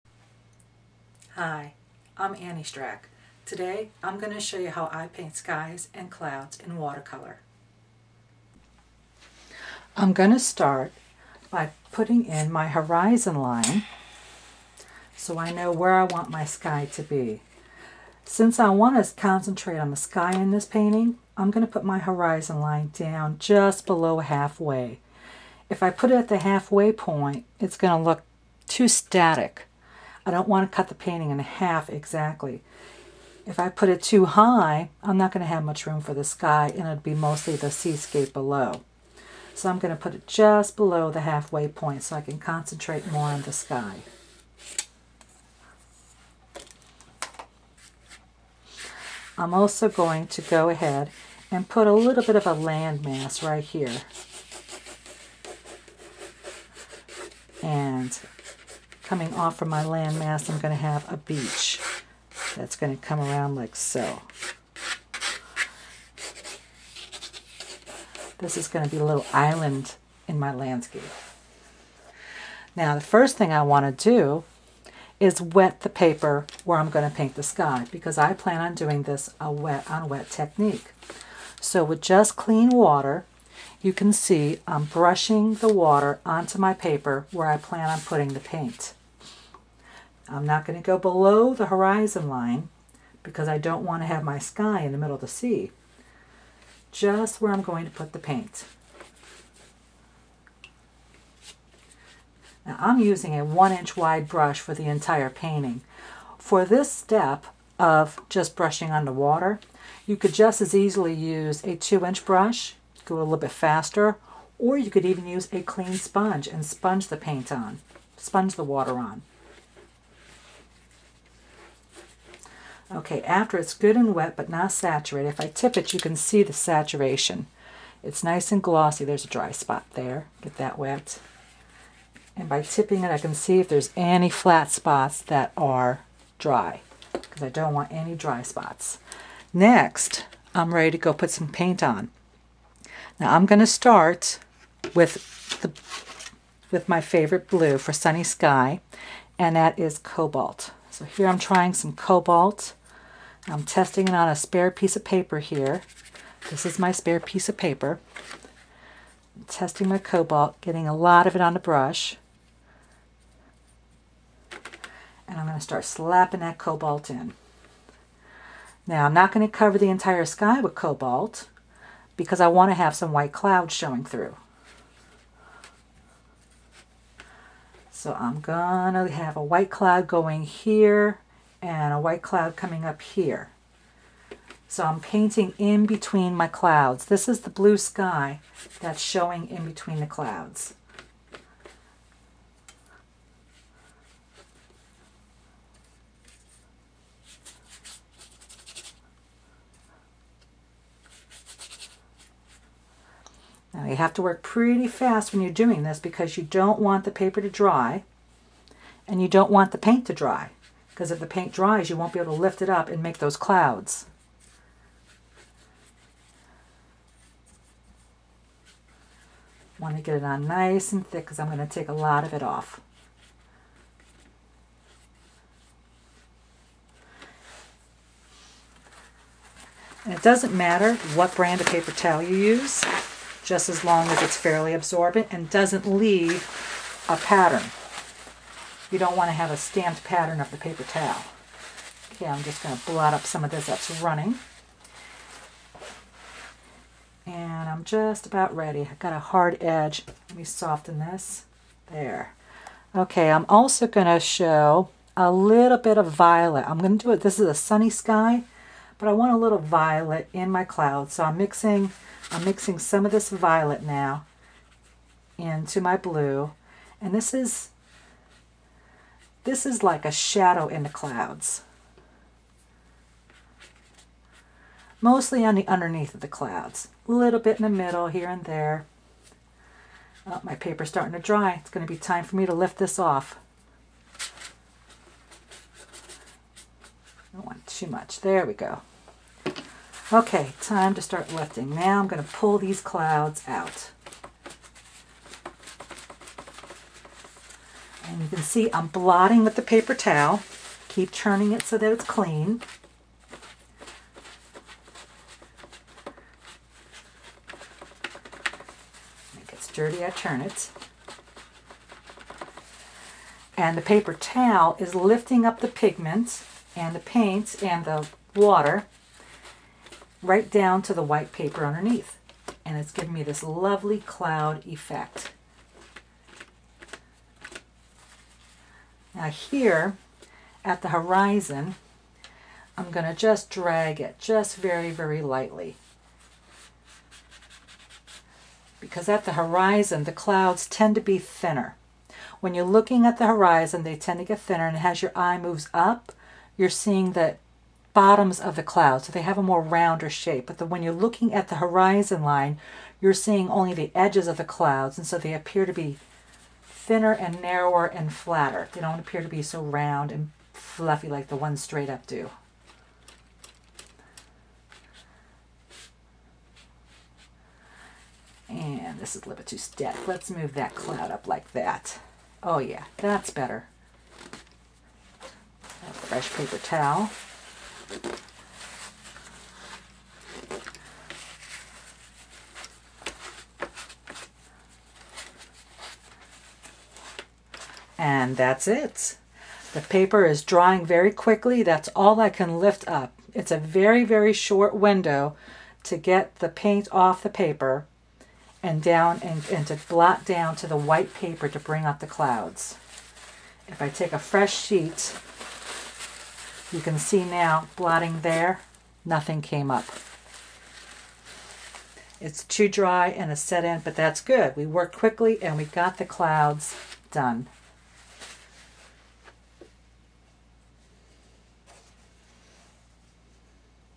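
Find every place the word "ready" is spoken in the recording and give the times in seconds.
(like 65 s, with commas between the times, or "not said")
140 s, 248 s.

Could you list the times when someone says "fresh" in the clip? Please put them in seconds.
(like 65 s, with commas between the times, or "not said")
375 s, 404 s.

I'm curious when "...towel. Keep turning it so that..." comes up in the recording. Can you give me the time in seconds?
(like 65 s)
299 s.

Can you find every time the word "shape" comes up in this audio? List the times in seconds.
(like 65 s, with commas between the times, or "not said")
350 s.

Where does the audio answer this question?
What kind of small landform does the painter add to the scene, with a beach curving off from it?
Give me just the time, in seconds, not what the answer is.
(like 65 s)
69 s.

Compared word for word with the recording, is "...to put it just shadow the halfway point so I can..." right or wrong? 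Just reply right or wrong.
wrong.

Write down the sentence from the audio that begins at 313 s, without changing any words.
And the paper towel is lifting up the pigments and the paints and the water right down to the white paper underneath.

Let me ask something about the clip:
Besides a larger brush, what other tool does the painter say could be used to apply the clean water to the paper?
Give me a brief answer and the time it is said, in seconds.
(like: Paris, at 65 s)
a clean sponge, at 115 s.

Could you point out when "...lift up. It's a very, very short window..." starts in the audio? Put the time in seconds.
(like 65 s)
392 s.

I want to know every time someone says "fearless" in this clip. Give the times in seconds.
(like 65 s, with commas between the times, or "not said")
not said.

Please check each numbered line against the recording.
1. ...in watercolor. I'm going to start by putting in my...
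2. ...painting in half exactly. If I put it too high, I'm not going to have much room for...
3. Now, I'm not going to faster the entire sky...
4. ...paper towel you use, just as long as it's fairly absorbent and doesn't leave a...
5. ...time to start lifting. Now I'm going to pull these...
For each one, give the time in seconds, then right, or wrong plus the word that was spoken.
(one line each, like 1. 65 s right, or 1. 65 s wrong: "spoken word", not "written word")
1. 6 s right
2. 30 s right
3. 168 s wrong: "cover", not "faster"
4. 231 s right
5. 290 s right.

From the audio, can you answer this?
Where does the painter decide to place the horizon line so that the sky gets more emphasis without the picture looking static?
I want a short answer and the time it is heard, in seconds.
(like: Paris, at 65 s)
just below halfway, at 23 s.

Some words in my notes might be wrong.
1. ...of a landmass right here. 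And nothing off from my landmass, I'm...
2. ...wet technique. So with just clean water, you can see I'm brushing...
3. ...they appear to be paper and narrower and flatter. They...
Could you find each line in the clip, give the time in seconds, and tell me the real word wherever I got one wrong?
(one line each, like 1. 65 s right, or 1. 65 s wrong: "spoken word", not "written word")
1. 52 s wrong: "coming", not "nothing"
2. 80 s right
3. 355 s wrong: "thinner", not "paper".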